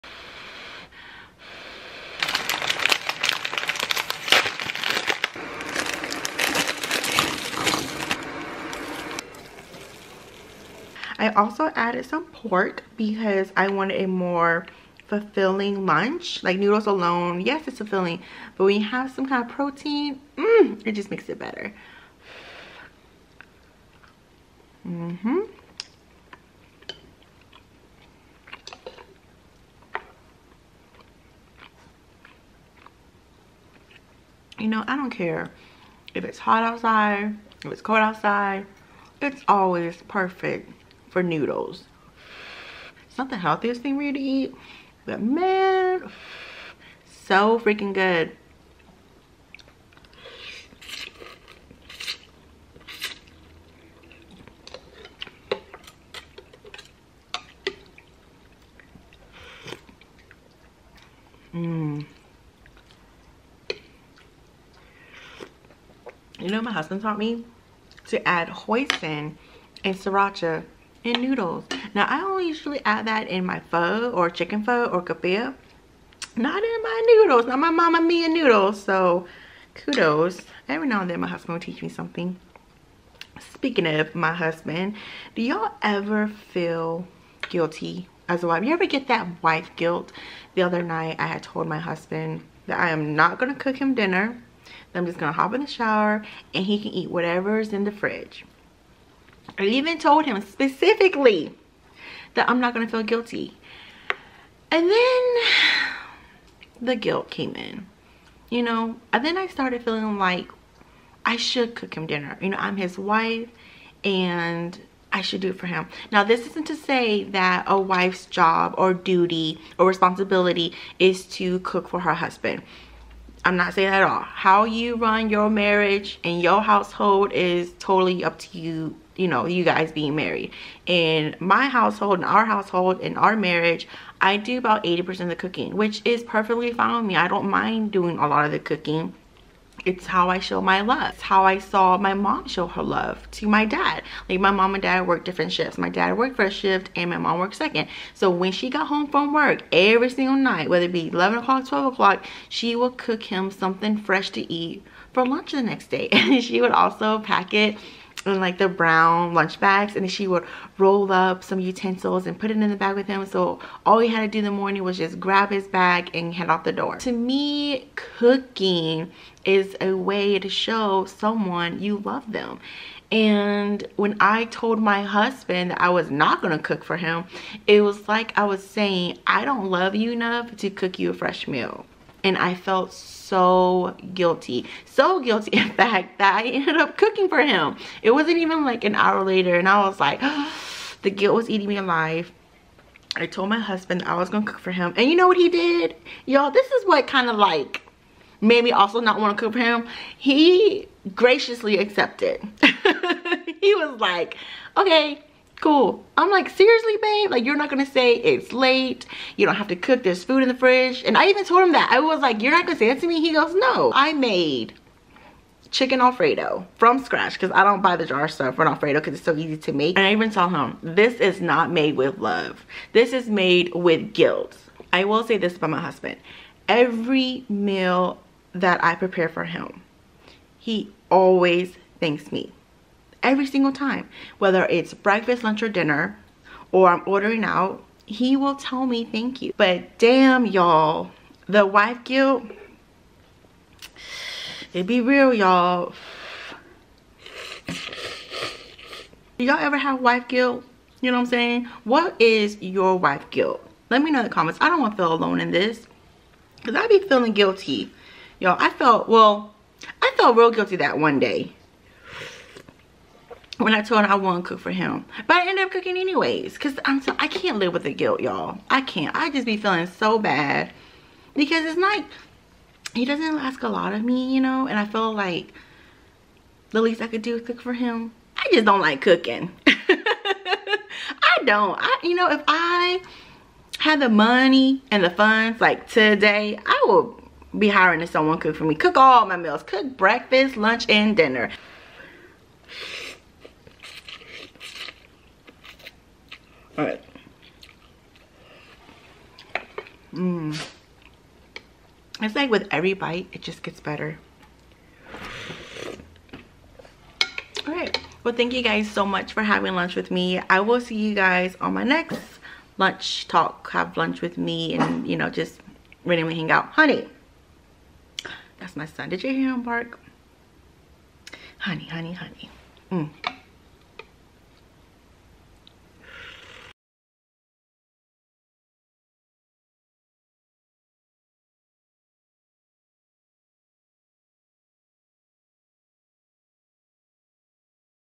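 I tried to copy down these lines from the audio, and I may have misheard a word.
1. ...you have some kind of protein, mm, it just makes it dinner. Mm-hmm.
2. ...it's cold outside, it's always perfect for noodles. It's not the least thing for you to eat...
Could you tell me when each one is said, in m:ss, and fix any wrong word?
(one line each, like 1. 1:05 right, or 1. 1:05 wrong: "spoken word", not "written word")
1. 0:18 wrong: "better", not "dinner"
2. 0:37 wrong: "healthiest", not "least".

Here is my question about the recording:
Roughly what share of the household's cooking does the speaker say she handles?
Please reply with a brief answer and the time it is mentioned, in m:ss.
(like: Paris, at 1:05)
80%, at 2:14.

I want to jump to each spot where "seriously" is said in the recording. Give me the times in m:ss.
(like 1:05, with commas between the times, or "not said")
3:26.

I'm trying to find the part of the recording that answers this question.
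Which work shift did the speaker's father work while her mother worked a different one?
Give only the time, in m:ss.
2:26.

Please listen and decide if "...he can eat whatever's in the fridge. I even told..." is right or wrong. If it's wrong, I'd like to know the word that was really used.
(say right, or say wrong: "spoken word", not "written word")
right.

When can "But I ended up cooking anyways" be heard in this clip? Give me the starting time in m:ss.
4:25.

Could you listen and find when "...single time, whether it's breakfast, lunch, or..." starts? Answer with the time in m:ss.
3:53.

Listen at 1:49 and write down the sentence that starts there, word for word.
And then I started feeling like I should cook him dinner.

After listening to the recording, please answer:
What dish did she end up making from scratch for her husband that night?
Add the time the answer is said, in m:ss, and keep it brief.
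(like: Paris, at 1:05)
chicken alfredo, at 3:35.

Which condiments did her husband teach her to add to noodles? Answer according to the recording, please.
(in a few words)
hoisin and sriracha.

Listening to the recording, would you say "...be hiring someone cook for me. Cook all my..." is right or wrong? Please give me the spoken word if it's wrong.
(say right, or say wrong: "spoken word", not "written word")
right.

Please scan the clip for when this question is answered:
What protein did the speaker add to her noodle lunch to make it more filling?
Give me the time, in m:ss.
0:12.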